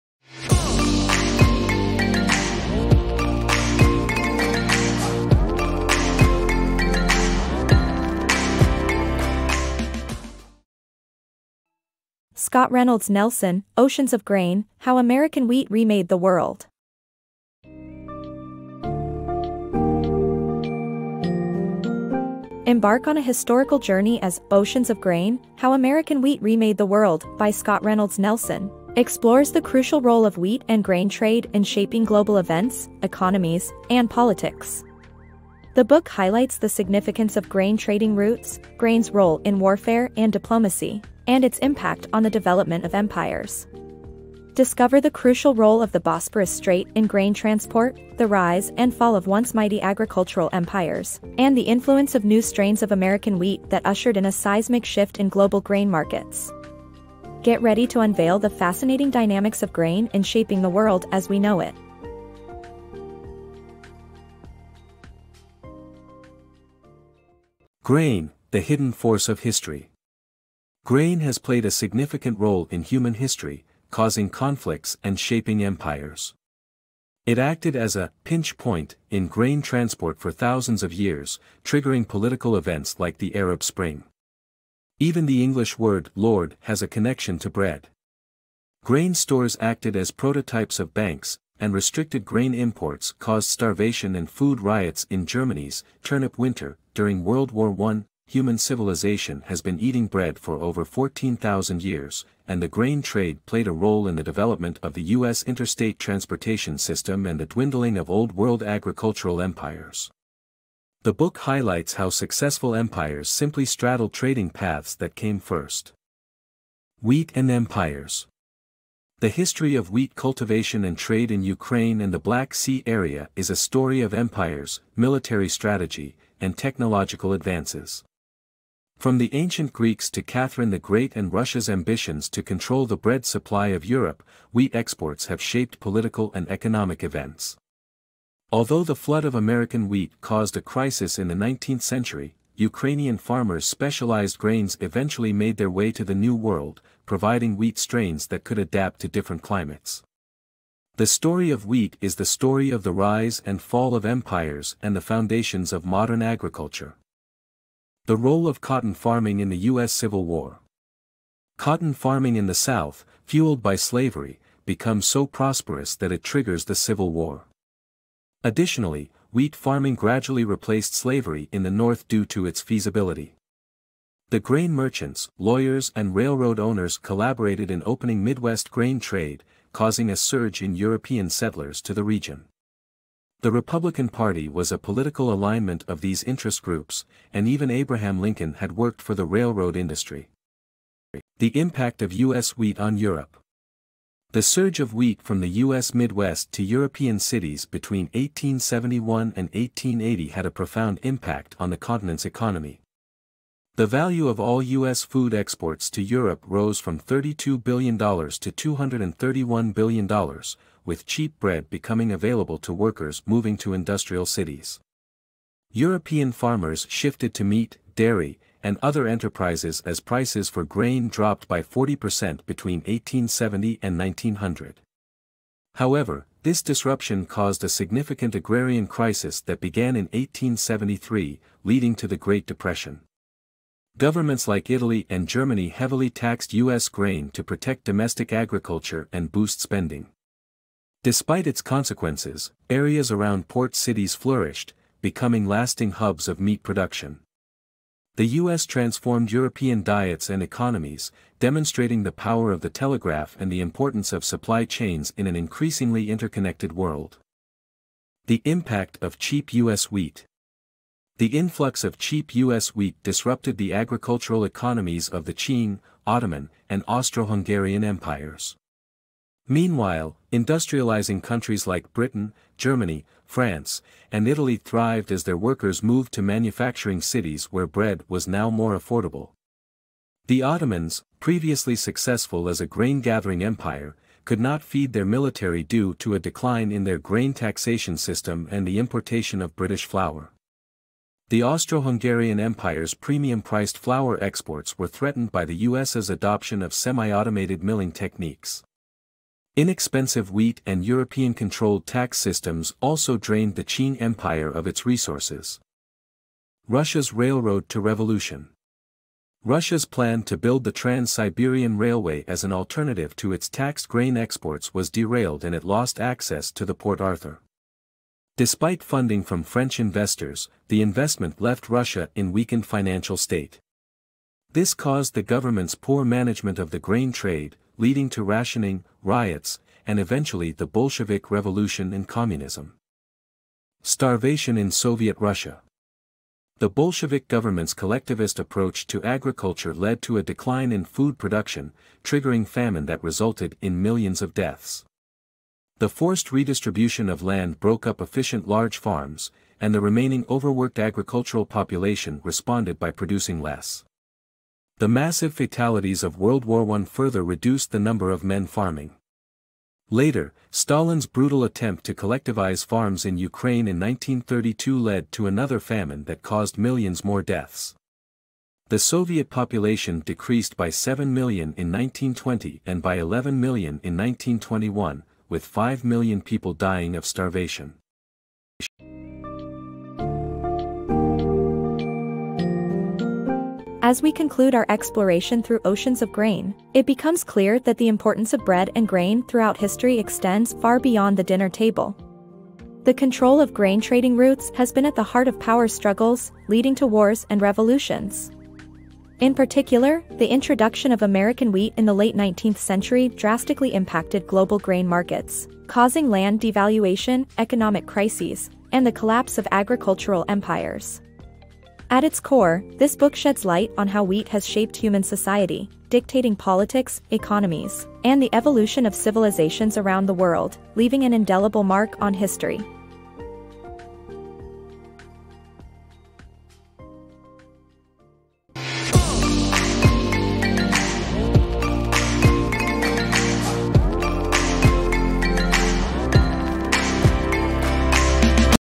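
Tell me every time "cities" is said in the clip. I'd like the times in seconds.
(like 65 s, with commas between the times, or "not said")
197 s, 214 s, 243 s, 277 s.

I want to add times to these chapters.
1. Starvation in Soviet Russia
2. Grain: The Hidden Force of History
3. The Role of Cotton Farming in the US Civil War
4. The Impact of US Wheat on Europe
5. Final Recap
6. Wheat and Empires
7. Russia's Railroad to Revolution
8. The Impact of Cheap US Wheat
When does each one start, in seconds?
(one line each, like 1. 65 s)
1. 334 s
2. 68 s
3. 158 s
4. 192 s
5. 379 s
6. 117 s
7. 307 s
8. 258 s.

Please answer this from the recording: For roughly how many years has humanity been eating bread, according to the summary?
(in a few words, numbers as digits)
14,000 years.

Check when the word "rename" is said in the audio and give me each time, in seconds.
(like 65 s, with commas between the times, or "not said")
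not said.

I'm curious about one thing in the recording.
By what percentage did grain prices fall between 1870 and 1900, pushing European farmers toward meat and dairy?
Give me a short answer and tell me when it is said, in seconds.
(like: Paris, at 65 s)
40%, at 221 s.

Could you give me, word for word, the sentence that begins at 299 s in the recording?
Inexpensive wheat and European-controlled tax systems also drained the Qing Empire of its resources.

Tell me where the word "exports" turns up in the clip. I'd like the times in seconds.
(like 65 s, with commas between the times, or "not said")
134 s, 205 s, 294 s, 314 s.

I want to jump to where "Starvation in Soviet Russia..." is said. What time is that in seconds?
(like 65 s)
333 s.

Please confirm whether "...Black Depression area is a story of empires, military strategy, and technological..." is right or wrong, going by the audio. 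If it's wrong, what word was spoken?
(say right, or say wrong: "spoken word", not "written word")
wrong: "Sea", not "Depression".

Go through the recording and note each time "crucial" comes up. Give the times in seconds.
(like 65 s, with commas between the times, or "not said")
29 s, 45 s.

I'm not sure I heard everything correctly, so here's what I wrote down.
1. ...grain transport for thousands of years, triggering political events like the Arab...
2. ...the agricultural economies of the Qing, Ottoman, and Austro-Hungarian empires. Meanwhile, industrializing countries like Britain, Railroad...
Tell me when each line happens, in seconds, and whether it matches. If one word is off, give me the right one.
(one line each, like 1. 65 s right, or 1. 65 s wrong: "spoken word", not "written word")
1. 79 s right
2. 263 s wrong: "Germany", not "Railroad".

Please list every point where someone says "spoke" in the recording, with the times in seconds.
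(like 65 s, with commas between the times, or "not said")
not said.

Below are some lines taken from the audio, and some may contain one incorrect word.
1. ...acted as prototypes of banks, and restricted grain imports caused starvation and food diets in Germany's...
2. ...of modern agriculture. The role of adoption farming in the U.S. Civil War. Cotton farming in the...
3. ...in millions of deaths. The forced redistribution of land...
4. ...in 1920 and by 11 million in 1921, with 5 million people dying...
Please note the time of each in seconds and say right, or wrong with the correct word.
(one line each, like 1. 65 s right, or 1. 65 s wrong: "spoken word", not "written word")
1. 89 s wrong: "riots", not "diets"
2. 155 s wrong: "cotton", not "adoption"
3. 343 s right
4. 371 s right.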